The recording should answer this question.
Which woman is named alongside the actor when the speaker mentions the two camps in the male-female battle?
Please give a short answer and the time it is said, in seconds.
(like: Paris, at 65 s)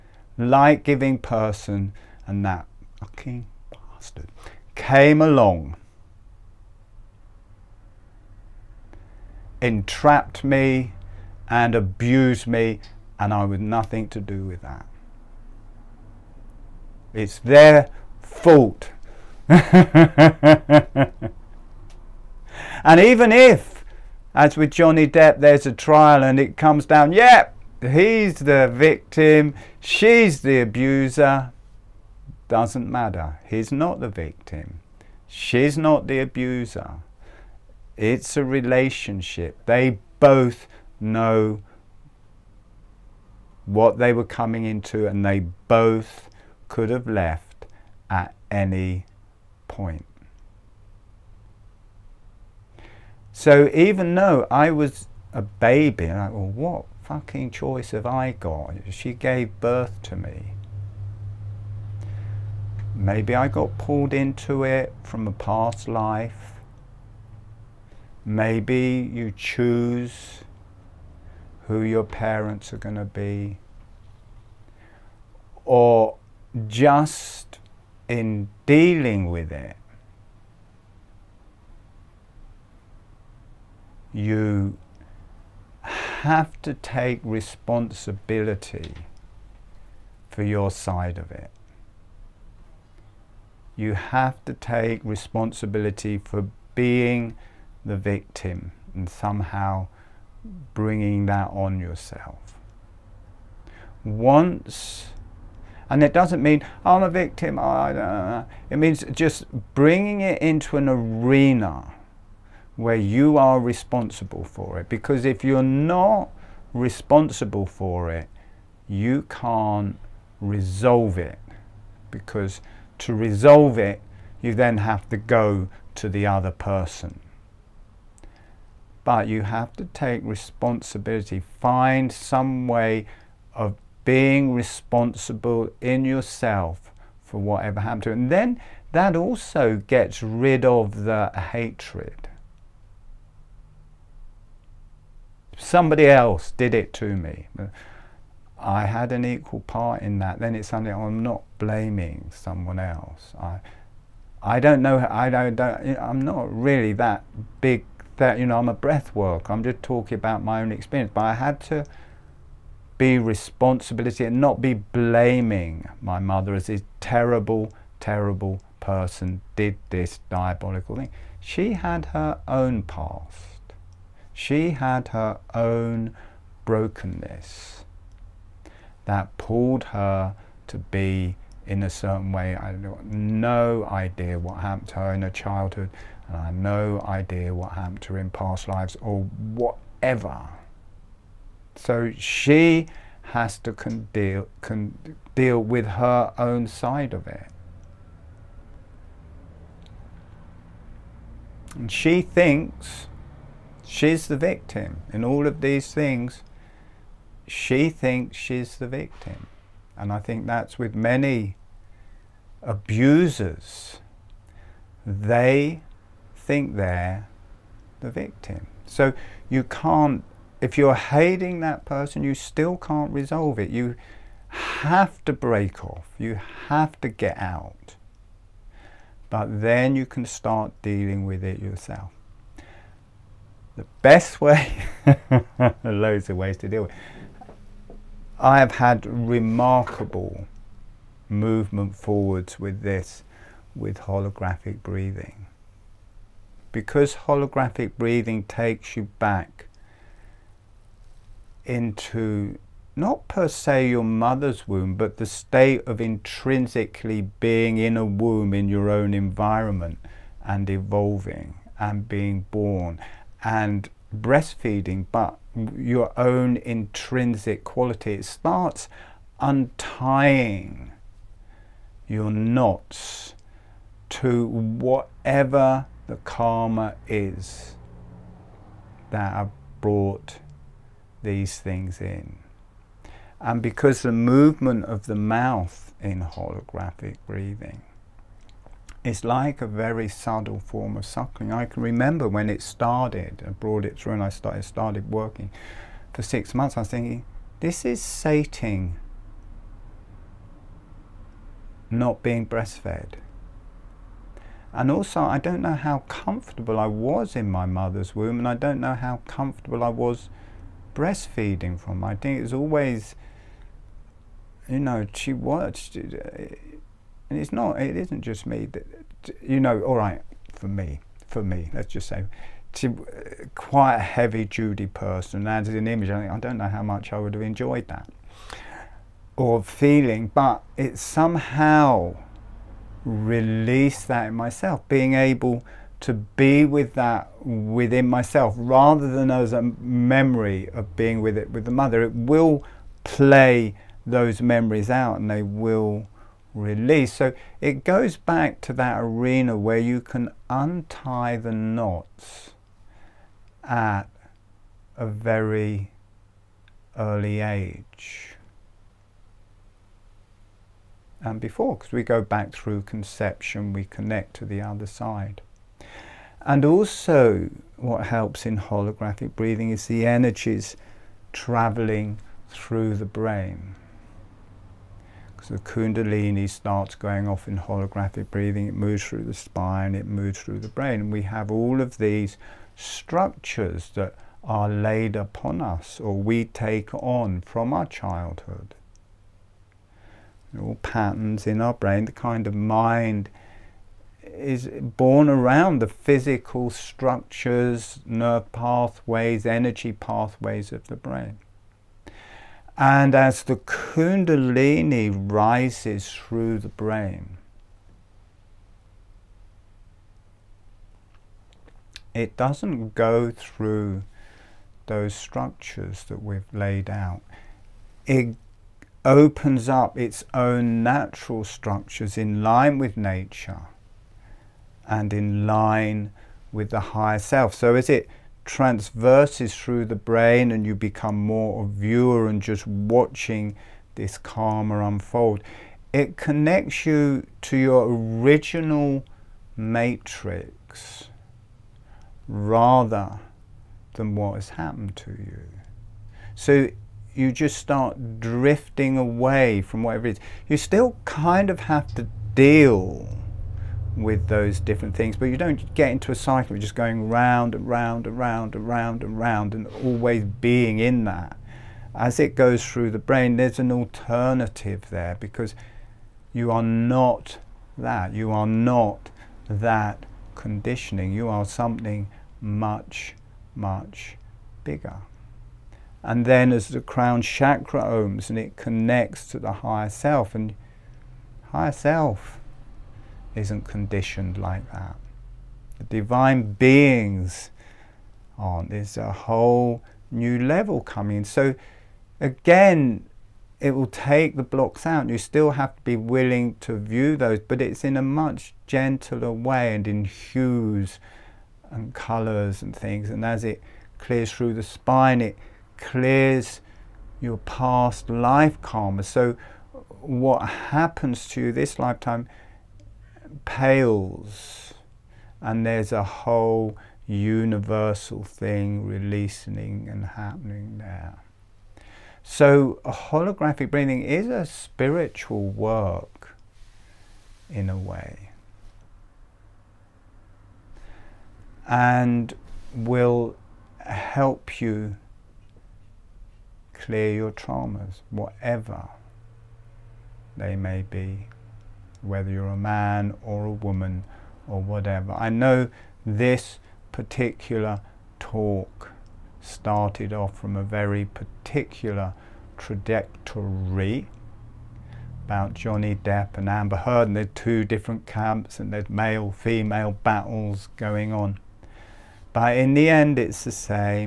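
Amber Heard, at 556 s.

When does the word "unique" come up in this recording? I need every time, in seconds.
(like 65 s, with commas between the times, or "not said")
not said.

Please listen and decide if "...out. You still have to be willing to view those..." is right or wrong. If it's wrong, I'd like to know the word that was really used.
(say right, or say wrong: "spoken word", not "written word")
right.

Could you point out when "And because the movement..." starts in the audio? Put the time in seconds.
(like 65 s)
283 s.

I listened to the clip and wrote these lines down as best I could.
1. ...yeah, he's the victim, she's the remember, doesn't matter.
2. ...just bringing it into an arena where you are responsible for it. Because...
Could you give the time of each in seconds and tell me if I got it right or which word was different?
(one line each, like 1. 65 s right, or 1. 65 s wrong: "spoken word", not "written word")
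1. 27 s wrong: "abuser", not "remember"
2. 109 s right.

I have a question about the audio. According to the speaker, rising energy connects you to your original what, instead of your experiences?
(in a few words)
matrix.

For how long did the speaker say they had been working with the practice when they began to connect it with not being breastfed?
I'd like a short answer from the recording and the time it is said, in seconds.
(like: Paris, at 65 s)
6 months, at 296 s.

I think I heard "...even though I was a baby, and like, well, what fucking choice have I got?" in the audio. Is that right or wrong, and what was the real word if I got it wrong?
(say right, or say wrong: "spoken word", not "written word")
right.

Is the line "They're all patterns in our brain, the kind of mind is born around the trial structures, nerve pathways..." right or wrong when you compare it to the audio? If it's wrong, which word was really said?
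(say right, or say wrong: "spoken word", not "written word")
wrong: "physical", not "trial".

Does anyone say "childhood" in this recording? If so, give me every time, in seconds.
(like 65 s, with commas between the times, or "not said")
185 s, 387 s.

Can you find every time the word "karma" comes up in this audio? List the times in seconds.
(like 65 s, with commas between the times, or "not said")
276 s, 434 s, 508 s.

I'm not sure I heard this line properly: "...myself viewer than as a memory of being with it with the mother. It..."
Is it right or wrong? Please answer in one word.
wrong.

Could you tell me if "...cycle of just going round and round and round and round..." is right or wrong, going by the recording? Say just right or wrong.
right.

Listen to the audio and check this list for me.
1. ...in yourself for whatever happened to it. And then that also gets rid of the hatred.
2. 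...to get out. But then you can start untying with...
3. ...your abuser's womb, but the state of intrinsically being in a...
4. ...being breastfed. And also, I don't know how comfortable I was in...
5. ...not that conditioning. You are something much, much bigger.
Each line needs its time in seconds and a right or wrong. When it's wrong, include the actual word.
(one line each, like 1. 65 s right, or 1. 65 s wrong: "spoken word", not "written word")
1. 135 s right
2. 227 s wrong: "dealing", not "untying"
3. 253 s wrong: "mother", not "abuser"
4. 302 s right
5. 468 s right.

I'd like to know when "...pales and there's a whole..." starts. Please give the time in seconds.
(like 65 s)
513 s.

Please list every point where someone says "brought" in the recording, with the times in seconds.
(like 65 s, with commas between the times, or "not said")
279 s, 293 s.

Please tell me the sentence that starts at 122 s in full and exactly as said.
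Because to resolve it, you then have to go to the other person but you have to take responsibility.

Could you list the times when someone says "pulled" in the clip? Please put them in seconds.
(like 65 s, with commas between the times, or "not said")
63 s, 179 s.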